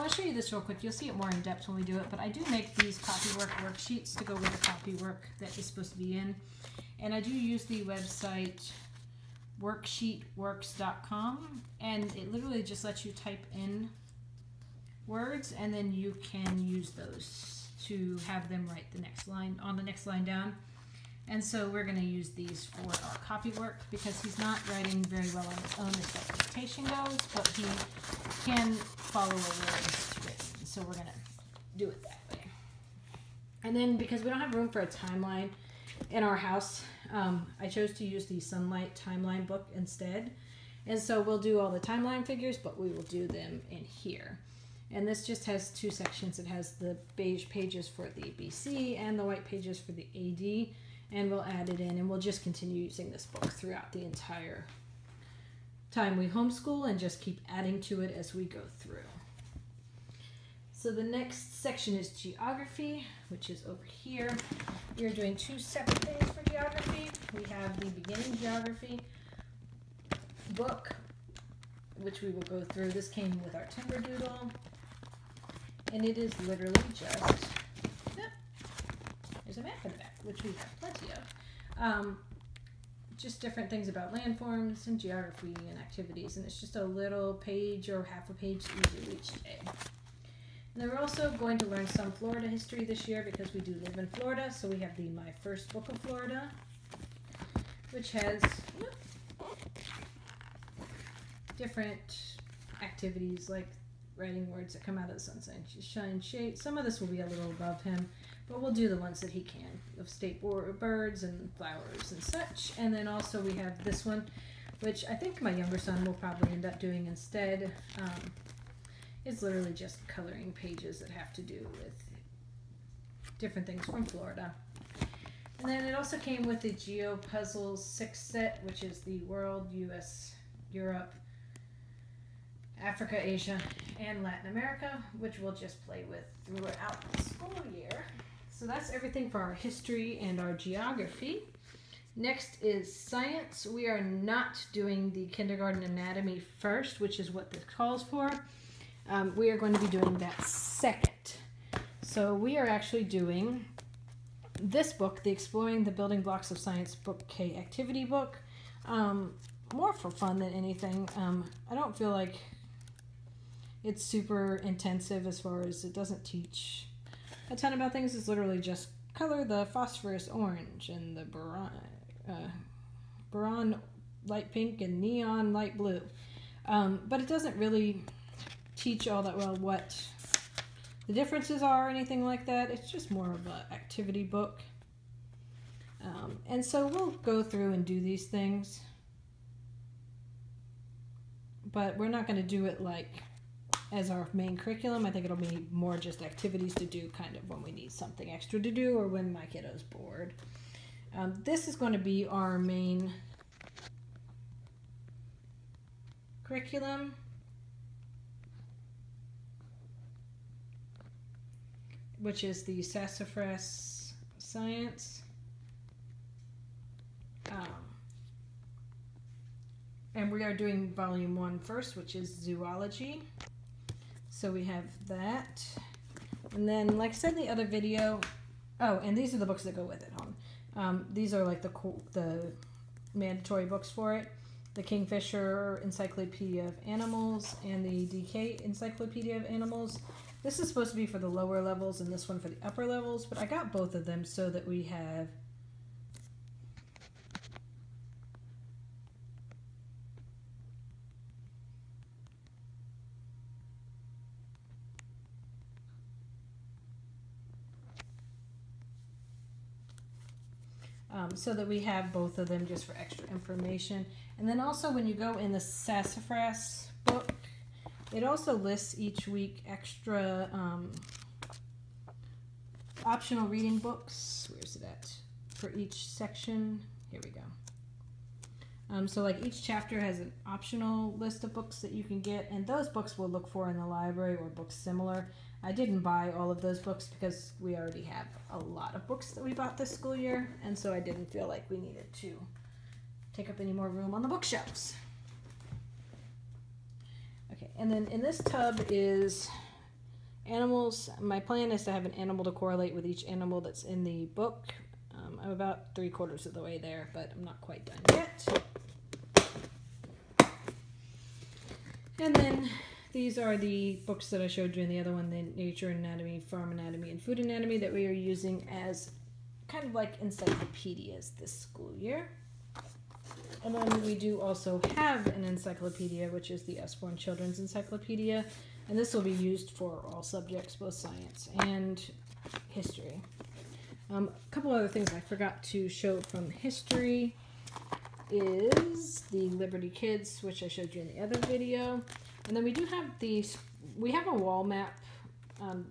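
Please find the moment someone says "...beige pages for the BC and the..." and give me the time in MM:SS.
00:47.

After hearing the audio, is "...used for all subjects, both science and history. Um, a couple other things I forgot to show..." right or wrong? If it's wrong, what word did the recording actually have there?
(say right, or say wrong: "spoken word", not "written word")
right.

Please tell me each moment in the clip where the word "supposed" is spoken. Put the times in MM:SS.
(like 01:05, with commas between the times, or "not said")
00:05, 04:00.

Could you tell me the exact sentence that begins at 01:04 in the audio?
You're doing two separate things for geography.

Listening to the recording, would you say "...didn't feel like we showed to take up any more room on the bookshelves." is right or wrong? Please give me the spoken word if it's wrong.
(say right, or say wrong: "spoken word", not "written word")
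wrong: "needed", not "showed".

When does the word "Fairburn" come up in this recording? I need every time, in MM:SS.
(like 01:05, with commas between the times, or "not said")
not said.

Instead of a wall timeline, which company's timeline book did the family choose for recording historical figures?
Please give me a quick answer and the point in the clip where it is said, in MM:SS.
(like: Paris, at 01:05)
Sonlight, at 00:38.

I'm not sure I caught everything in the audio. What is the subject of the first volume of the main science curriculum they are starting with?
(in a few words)
zoology.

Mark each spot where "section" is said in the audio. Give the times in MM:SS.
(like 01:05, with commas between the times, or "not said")
00:45, 01:01, 04:36.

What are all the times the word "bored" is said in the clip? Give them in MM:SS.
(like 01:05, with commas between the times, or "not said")
03:19.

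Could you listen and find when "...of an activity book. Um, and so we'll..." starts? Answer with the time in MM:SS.
03:03.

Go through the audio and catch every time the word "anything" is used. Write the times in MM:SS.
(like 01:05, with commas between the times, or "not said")
02:40, 03:01.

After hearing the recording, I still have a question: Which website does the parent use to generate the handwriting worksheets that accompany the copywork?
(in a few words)
worksheetworks.com.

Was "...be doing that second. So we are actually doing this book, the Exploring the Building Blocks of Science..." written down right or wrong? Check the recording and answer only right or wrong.
right.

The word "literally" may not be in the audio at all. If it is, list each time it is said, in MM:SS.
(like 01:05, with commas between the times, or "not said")
00:12, 01:16, 01:59, 02:48.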